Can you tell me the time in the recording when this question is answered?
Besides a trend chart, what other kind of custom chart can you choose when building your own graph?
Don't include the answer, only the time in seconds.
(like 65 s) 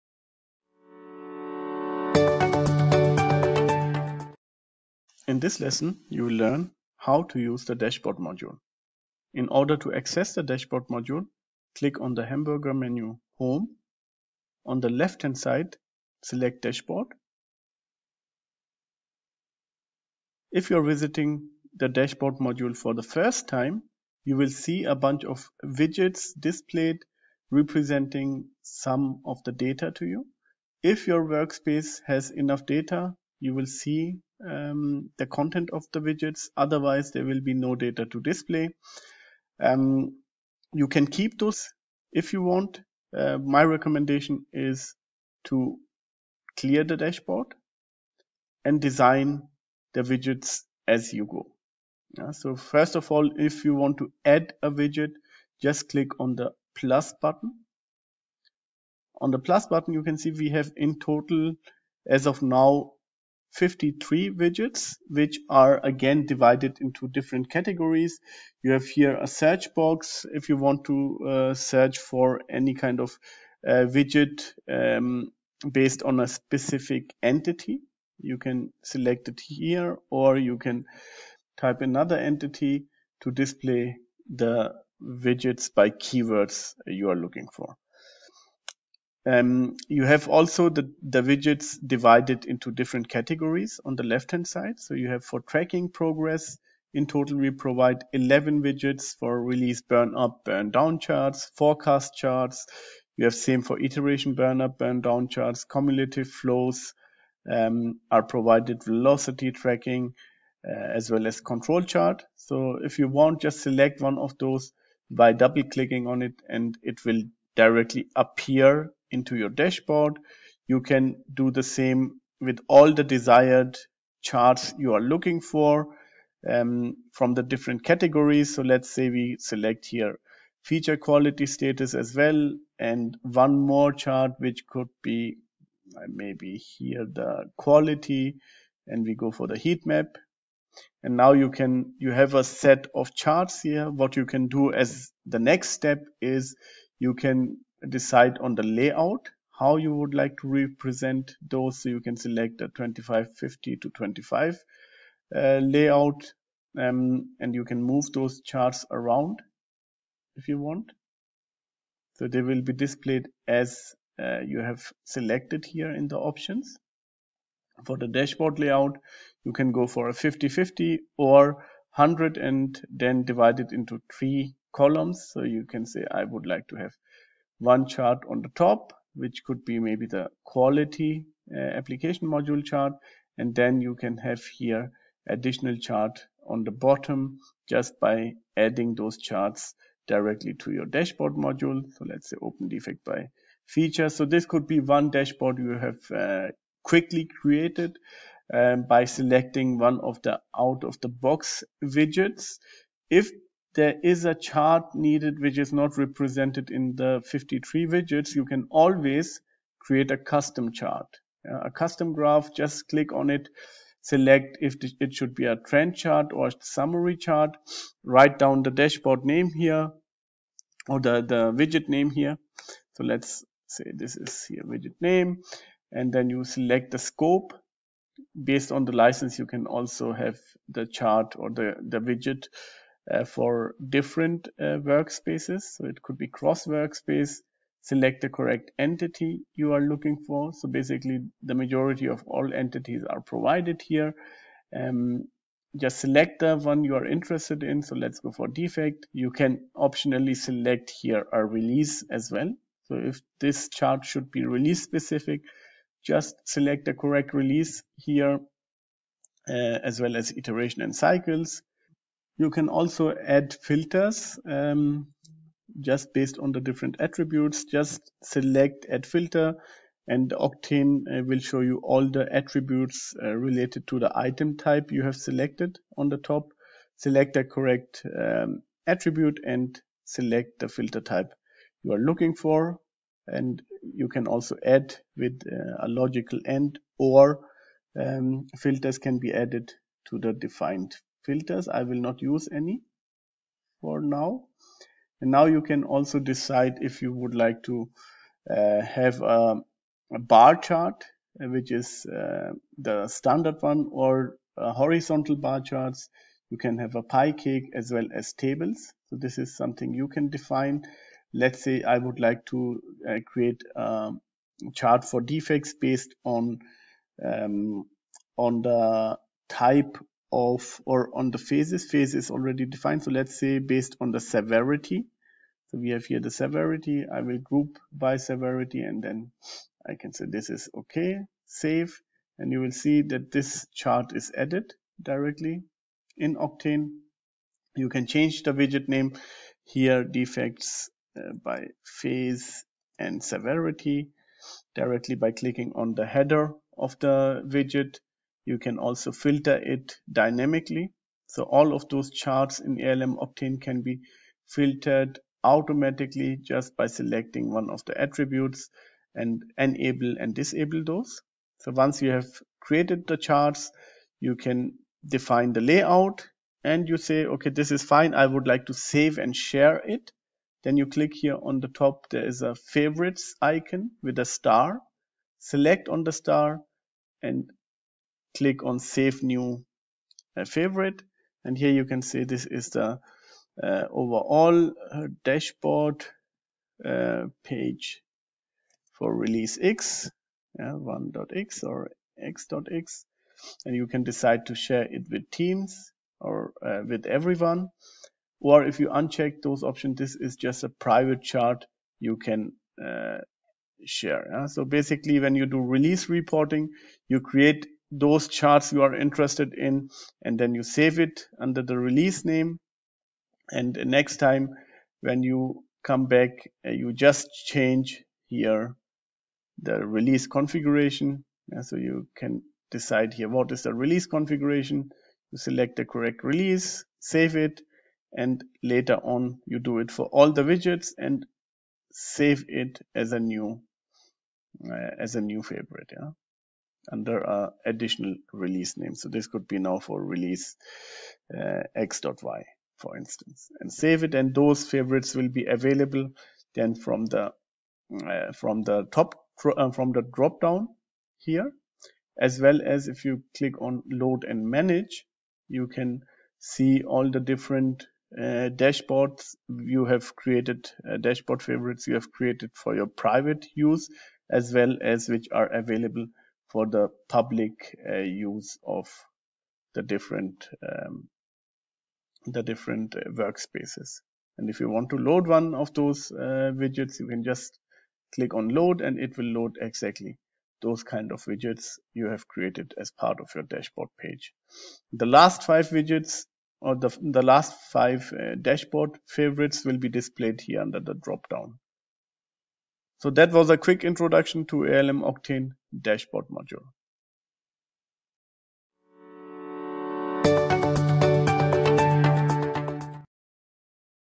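216 s.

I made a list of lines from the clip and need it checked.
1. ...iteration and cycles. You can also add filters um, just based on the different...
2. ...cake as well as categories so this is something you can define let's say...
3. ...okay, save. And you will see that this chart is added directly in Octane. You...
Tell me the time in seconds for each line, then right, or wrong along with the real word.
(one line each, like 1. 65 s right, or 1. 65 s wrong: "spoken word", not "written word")
1. 260 s right
2. 307 s wrong: "tables", not "categories"
3. 330 s right.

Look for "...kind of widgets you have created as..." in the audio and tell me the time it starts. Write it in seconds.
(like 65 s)
480 s.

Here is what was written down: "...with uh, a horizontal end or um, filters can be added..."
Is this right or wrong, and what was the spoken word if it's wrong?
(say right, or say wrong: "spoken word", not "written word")
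wrong: "logical", not "horizontal".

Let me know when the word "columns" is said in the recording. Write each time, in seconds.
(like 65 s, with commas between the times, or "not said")
174 s.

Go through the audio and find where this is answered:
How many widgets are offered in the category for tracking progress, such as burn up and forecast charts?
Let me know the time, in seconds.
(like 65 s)
98 s.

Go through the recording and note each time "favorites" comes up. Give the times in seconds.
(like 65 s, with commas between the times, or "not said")
372 s, 380 s, 435 s, 444 s, 461 s, 489 s.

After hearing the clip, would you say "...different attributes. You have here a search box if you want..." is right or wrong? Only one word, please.
wrong.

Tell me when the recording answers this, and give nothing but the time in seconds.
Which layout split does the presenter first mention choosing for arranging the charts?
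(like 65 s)
152 s.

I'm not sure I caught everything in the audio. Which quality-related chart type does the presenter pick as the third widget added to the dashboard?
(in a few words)
heat map.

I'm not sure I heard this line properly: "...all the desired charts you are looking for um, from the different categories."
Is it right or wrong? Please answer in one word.
right.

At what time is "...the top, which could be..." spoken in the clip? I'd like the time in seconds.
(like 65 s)
178 s.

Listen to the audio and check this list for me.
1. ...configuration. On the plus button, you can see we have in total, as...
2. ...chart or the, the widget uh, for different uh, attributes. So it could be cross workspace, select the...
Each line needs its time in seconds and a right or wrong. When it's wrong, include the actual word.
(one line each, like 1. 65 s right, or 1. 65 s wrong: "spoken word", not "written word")
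1. 57 s wrong: "button", not "configuration"
2. 230 s wrong: "workspaces", not "attributes".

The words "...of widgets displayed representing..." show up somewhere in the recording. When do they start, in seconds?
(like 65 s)
25 s.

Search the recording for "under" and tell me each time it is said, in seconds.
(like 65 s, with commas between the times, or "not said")
411 s, 490 s.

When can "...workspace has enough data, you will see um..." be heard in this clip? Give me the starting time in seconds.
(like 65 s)
31 s.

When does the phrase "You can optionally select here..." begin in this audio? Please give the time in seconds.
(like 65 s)
249 s.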